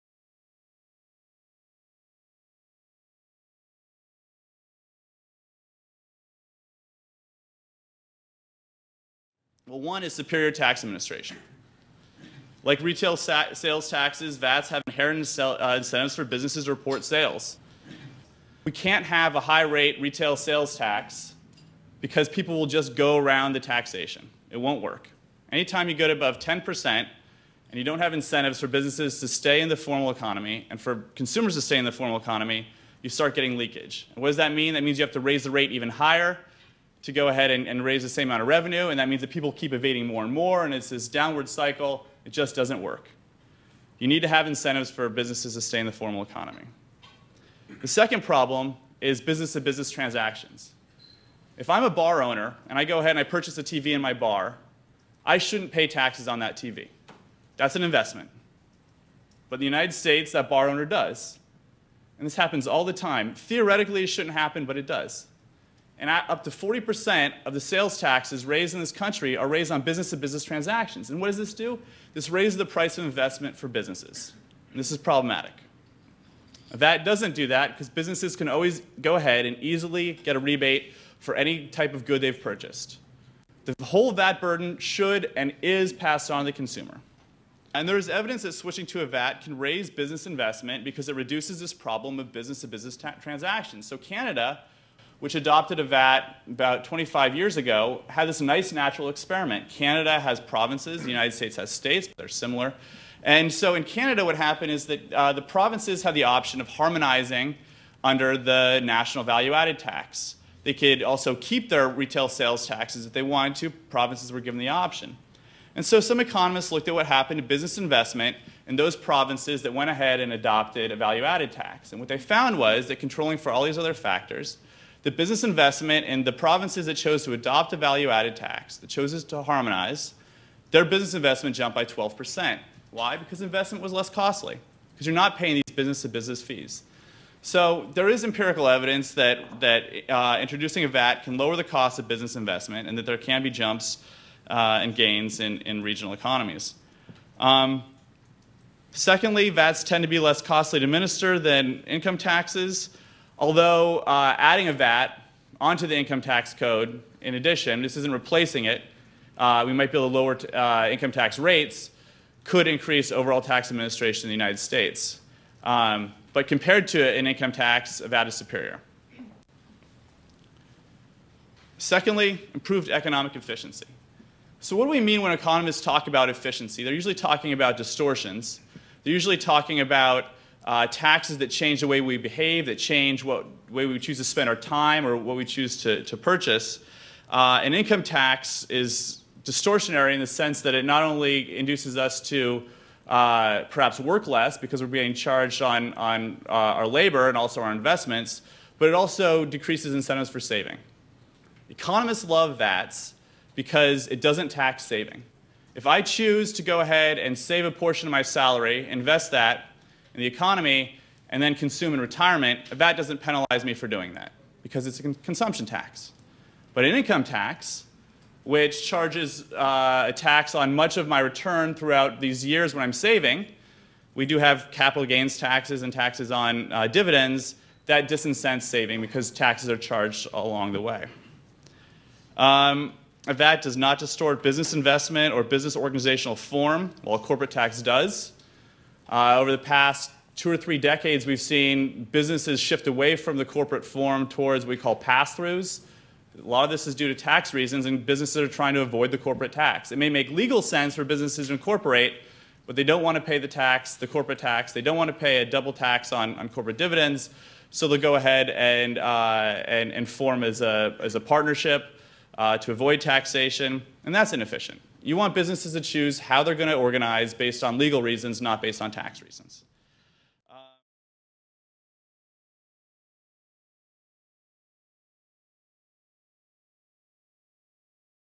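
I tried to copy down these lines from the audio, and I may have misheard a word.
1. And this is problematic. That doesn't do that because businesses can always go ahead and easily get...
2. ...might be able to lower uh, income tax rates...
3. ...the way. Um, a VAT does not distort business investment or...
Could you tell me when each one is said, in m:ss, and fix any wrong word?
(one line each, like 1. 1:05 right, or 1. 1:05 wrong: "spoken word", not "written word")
1. 1:14 right
2. 2:39 right
3. 3:50 right.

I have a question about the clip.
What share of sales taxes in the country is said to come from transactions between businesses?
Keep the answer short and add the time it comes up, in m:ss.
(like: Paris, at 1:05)
up to 40%, at 1:06.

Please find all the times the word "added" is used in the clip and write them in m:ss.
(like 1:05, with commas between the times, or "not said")
1:49, 2:01, 2:08.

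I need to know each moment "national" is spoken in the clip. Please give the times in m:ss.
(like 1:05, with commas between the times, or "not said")
1:48.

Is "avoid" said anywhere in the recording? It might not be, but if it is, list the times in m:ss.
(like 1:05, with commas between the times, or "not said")
4:08, 4:22.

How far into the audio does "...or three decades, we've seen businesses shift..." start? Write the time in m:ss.
4:00.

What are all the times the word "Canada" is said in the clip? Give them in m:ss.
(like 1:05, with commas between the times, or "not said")
1:33, 1:39, 1:43.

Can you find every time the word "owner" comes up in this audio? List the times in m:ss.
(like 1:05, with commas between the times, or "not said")
0:52, 1:00.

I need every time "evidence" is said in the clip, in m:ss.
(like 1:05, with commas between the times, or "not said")
1:28, 2:18.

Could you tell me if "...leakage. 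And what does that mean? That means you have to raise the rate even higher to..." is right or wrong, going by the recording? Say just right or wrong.
right.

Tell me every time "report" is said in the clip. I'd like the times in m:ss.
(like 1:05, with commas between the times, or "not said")
0:16.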